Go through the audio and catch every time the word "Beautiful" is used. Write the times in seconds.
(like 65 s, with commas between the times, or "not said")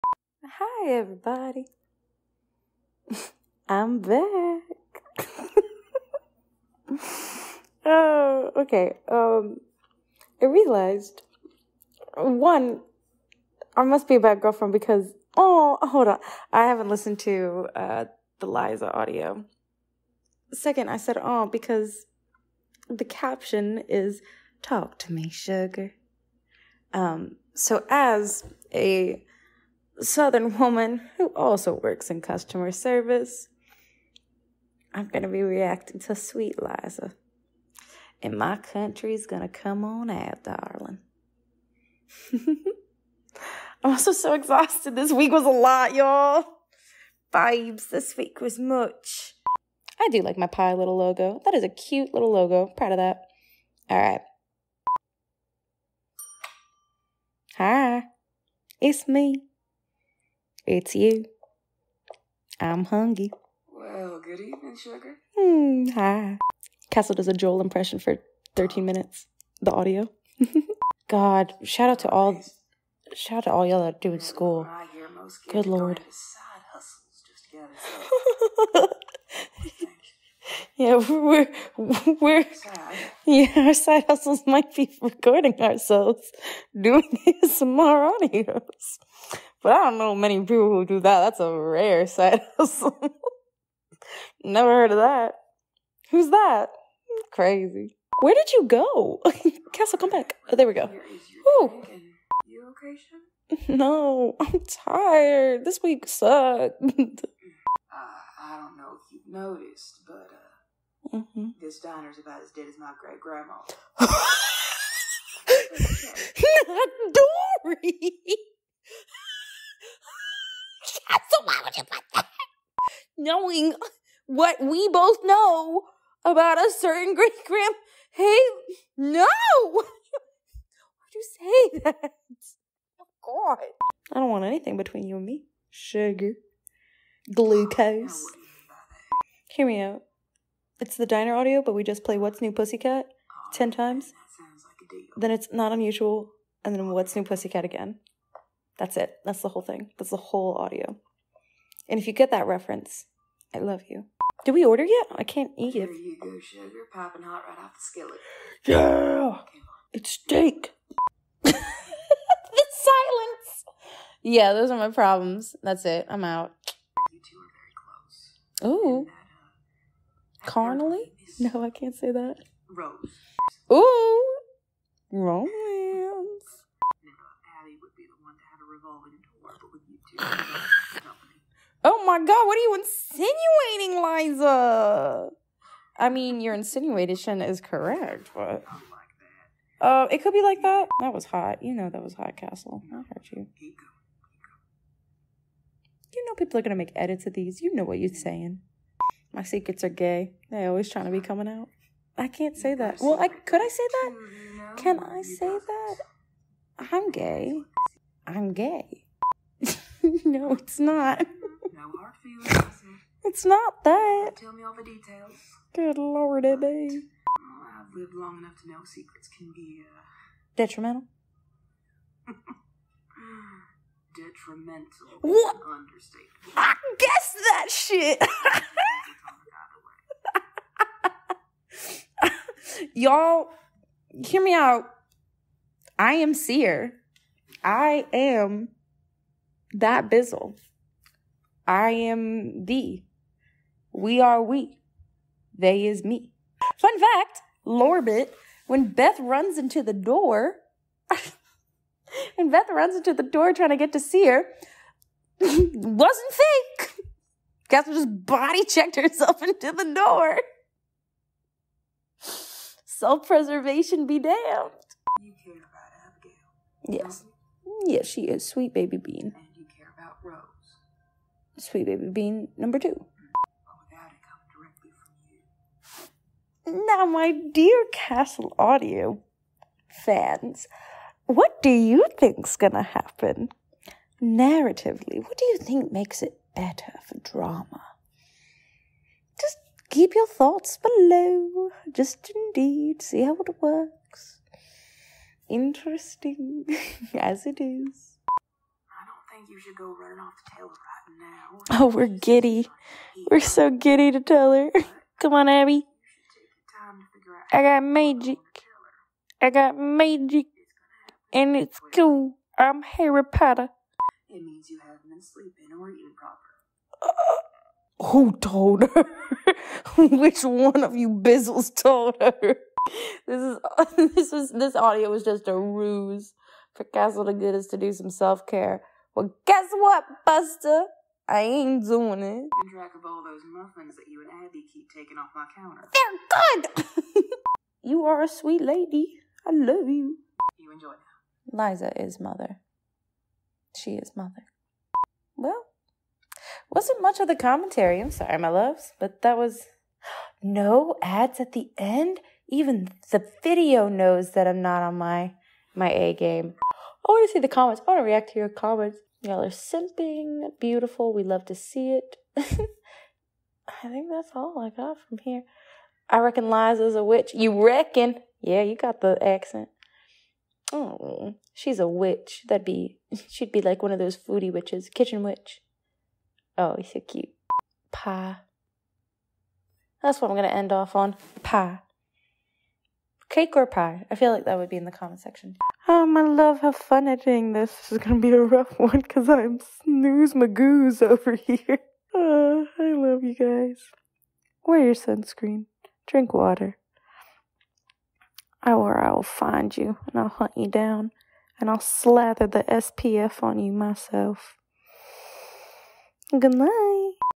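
360 s.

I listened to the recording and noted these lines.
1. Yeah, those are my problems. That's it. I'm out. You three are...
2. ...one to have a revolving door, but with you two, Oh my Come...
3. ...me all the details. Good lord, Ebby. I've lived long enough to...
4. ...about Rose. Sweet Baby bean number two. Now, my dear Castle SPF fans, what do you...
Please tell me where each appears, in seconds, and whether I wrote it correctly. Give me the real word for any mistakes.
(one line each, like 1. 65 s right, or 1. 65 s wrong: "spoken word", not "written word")
1. 164 s wrong: "two", not "three"
2. 178 s wrong: "God", not "Come"
3. 214 s right
4. 269 s wrong: "Audio", not "SPF".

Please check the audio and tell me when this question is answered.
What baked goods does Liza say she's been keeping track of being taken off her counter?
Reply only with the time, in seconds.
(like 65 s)
333 s.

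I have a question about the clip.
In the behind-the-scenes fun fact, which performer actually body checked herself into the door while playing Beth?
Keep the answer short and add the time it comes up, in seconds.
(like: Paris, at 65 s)
Catherine, at 257 s.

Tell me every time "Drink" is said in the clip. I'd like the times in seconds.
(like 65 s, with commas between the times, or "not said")
396 s.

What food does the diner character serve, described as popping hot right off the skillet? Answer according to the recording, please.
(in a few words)
Steak.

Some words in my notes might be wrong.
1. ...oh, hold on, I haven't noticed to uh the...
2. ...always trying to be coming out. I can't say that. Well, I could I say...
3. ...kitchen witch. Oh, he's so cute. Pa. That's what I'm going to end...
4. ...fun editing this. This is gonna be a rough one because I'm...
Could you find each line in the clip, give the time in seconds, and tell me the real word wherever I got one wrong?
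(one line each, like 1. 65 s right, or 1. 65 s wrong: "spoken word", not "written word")
1. 15 s wrong: "listened", not "noticed"
2. 200 s right
3. 374 s right
4. 386 s right.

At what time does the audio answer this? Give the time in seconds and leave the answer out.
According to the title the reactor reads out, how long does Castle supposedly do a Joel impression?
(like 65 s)
68 s.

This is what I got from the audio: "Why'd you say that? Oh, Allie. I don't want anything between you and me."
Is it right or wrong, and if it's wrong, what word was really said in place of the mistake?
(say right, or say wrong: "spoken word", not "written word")
wrong: "God", not "Allie".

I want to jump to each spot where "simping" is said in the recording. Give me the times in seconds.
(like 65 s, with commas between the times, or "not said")
359 s.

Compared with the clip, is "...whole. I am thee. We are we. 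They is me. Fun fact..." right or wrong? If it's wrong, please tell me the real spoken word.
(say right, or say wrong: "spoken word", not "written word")
wrong: "bizzle", not "whole".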